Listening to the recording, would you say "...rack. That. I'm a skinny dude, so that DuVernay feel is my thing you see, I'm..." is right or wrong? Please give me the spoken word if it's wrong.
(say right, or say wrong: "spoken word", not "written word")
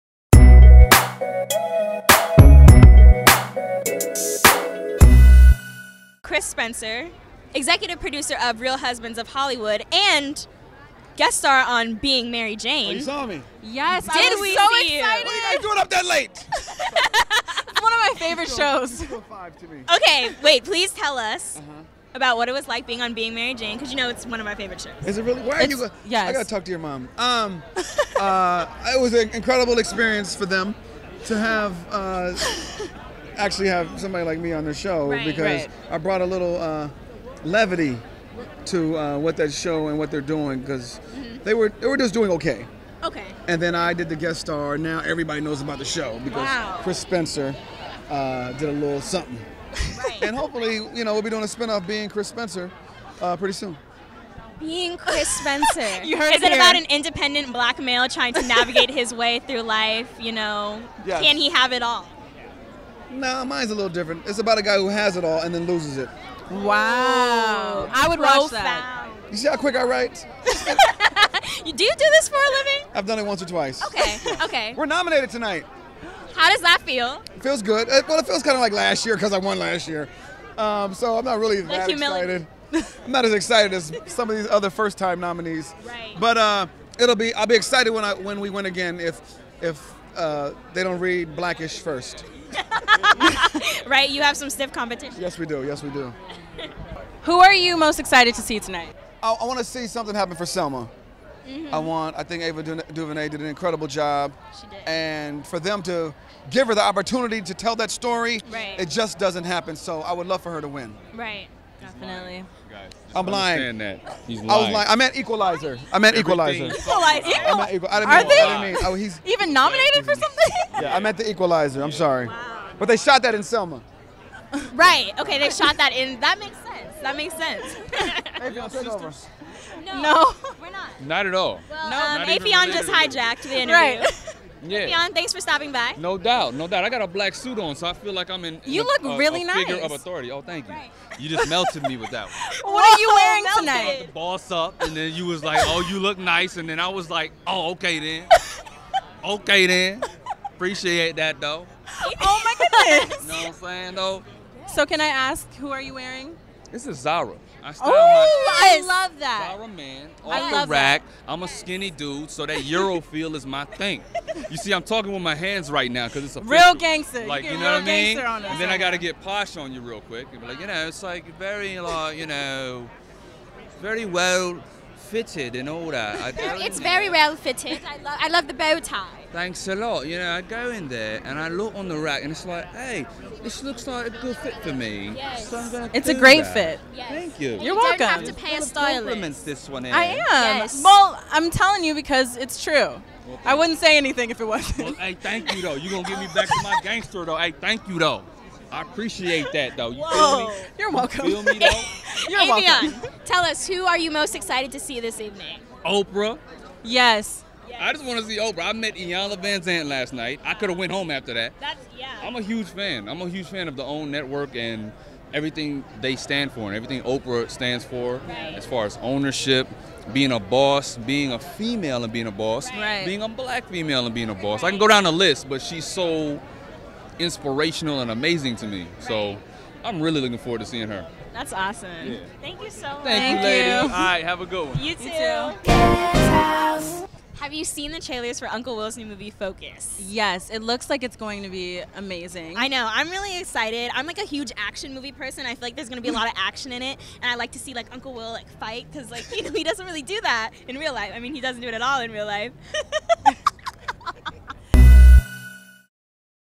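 wrong: "Euro", not "DuVernay".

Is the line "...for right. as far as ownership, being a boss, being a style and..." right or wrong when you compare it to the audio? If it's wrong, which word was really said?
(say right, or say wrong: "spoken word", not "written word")
wrong: "female", not "style".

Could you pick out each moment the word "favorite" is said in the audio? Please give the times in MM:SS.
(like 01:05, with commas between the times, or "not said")
00:18, 00:24.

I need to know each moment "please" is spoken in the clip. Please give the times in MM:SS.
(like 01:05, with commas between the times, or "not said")
00:20.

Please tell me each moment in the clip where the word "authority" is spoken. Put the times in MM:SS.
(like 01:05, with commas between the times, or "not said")
02:19.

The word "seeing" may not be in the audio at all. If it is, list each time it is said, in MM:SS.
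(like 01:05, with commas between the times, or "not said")
03:50.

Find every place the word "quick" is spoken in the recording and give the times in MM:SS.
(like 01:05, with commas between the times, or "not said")
01:09, 02:50.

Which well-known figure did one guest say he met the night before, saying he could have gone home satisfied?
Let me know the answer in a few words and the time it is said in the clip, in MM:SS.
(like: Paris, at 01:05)
Iyanla Vanzant, at 03:28.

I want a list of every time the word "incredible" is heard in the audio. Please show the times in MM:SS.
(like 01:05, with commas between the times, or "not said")
00:29, 01:43.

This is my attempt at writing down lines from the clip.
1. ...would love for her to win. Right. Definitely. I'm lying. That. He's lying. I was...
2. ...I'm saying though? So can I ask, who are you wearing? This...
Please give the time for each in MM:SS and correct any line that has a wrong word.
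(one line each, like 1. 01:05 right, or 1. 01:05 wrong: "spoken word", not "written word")
1. 01:50 right
2. 02:33 right.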